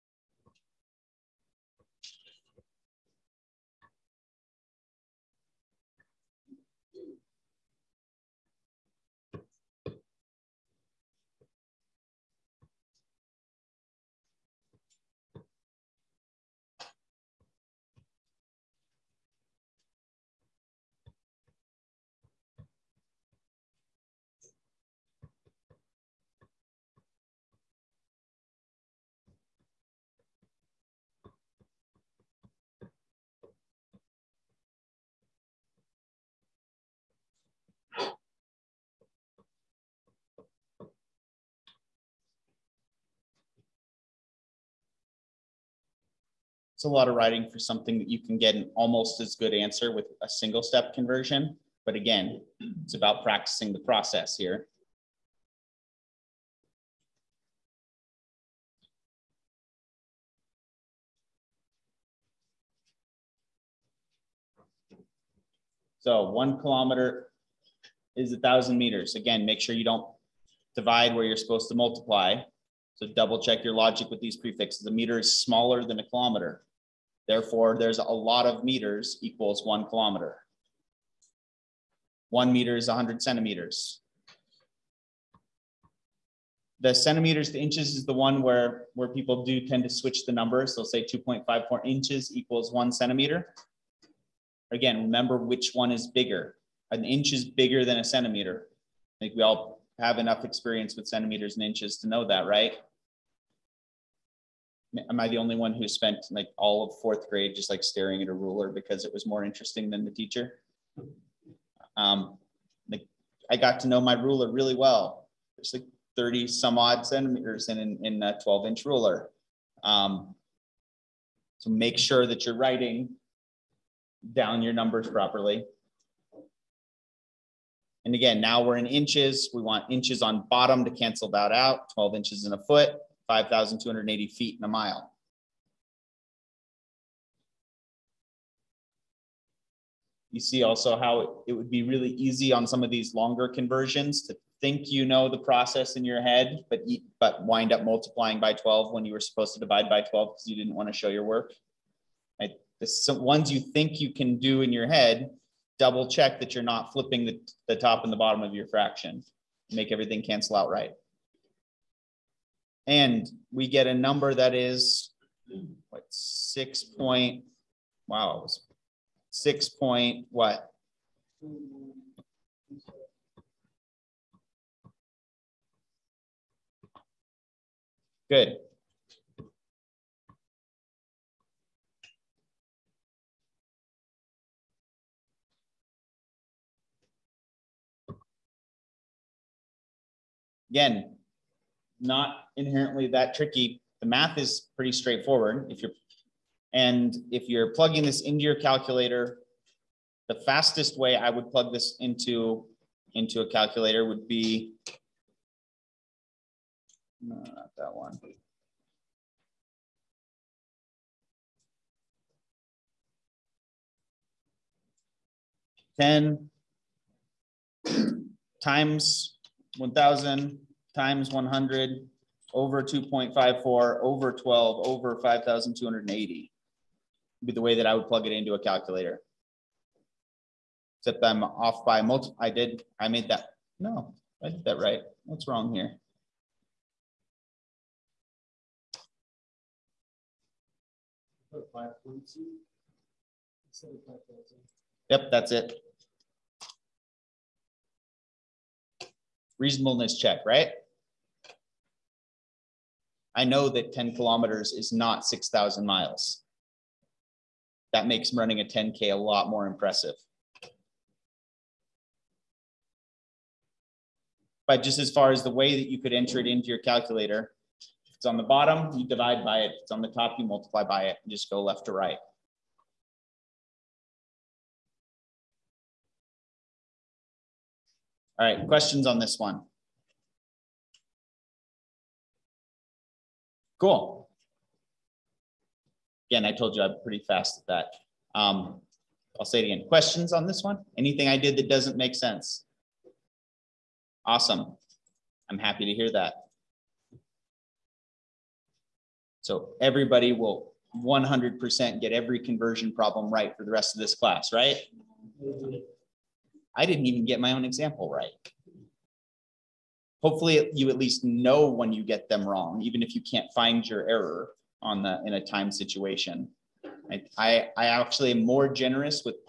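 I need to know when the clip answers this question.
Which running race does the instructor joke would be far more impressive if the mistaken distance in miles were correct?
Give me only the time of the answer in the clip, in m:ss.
4:18.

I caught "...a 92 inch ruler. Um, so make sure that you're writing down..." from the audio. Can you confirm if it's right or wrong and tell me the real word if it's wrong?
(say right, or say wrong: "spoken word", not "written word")
wrong: "12", not "92".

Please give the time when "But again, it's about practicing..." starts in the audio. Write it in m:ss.
0:51.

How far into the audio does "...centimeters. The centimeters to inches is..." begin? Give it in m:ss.
1:23.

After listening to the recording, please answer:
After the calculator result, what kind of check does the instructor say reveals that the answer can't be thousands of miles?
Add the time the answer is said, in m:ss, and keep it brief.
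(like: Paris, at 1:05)
reasonableness check, at 4:09.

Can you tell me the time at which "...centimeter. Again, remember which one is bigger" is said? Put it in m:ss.
1:32.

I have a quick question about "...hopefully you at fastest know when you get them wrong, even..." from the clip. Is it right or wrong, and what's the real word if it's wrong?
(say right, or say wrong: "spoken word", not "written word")
wrong: "least", not "fastest".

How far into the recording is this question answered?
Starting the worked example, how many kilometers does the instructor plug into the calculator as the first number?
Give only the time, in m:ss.
3:35.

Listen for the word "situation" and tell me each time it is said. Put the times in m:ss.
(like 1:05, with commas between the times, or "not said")
5:15.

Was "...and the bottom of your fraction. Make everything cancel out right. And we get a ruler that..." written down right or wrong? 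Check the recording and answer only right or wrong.
wrong.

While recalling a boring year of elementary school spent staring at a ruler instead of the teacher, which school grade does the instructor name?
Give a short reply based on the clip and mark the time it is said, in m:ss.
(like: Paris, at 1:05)
fourth grade, at 1:47.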